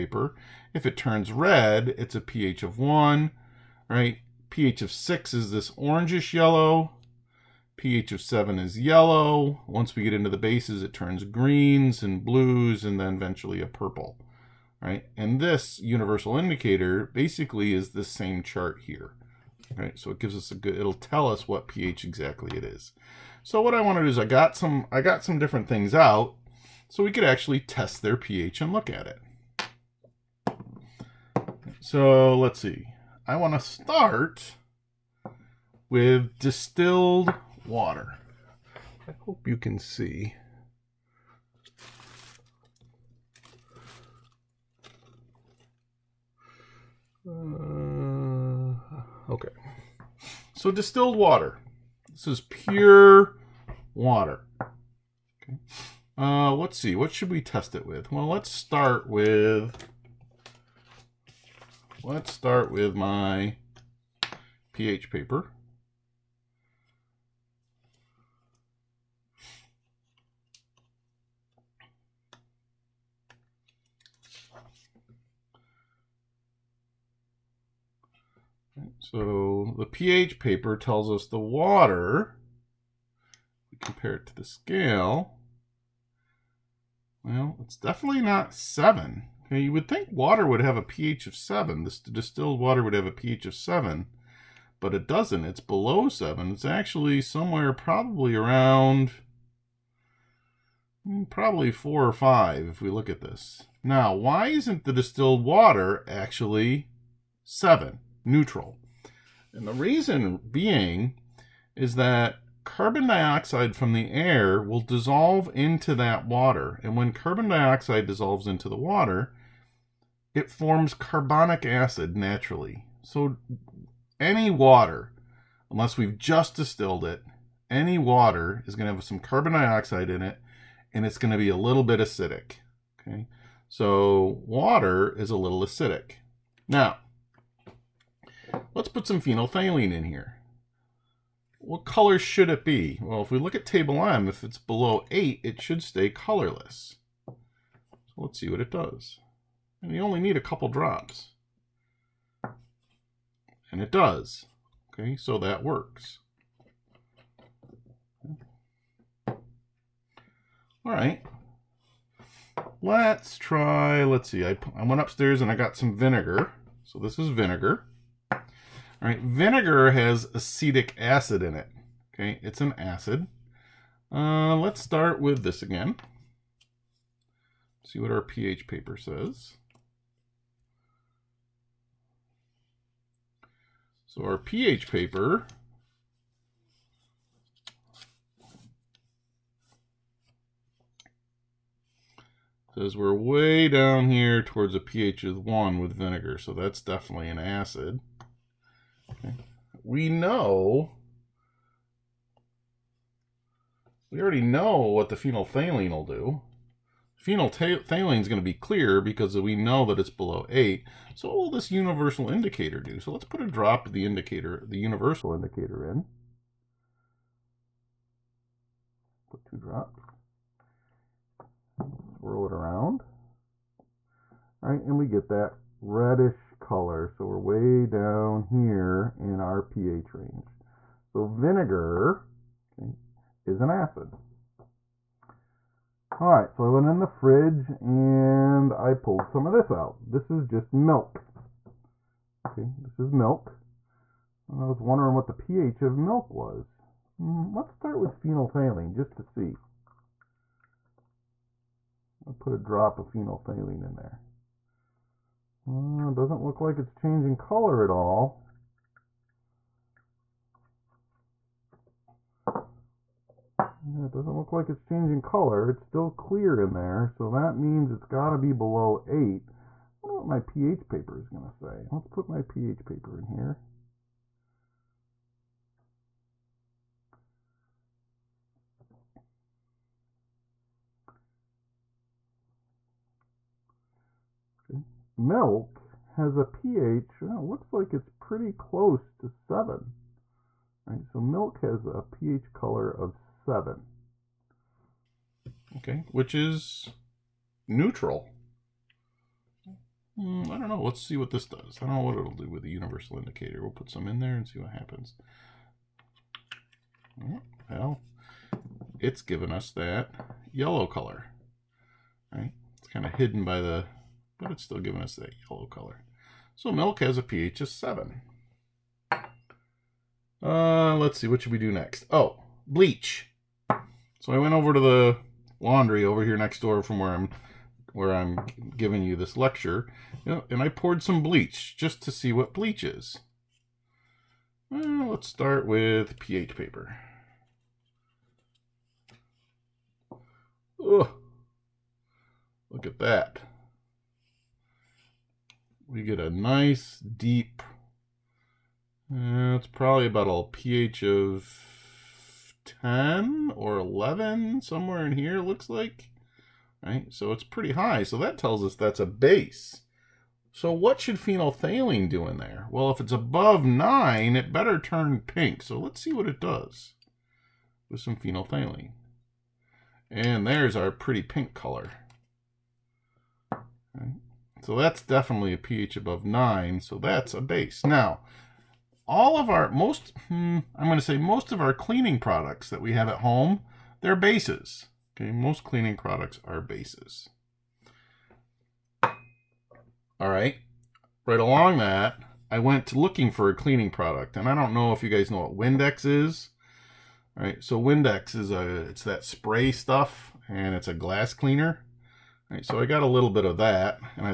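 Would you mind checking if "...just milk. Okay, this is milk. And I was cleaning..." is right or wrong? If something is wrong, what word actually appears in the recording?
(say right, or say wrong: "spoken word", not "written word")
wrong: "wondering", not "cleaning".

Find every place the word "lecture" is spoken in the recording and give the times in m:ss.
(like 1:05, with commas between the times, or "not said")
5:29.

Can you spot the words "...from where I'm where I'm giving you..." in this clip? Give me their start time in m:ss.
5:26.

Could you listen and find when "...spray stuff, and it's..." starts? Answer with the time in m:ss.
6:39.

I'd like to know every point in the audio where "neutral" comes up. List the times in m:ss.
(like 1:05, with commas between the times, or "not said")
1:48, 4:57.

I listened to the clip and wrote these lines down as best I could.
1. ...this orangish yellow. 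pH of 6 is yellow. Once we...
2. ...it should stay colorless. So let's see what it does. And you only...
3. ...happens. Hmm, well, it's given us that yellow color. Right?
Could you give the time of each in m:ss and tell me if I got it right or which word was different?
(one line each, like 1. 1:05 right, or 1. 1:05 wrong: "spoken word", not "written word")
1. 0:05 wrong: "7", not "6"
2. 2:25 right
3. 5:04 right.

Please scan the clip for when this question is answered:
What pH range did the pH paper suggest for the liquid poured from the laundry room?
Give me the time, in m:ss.
5:52.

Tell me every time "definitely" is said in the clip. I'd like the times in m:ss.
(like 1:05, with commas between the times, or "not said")
1:27, 3:16, 6:15.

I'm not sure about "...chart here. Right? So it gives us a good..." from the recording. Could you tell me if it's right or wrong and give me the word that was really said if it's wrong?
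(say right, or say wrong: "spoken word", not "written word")
right.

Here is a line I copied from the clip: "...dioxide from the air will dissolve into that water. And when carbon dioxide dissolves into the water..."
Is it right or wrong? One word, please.
right.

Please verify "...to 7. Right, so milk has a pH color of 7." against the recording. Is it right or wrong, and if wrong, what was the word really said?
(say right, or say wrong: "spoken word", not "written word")
right.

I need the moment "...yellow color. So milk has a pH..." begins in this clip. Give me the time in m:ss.
5:15.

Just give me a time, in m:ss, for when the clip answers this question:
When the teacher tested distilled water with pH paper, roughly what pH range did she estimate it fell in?
1:41.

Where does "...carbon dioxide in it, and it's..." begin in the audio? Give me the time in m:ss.
2:09.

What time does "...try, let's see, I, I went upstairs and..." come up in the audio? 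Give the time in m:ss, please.
2:43.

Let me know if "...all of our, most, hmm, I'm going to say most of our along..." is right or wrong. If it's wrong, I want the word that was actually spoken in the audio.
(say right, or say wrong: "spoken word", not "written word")
wrong: "cleaning", not "along".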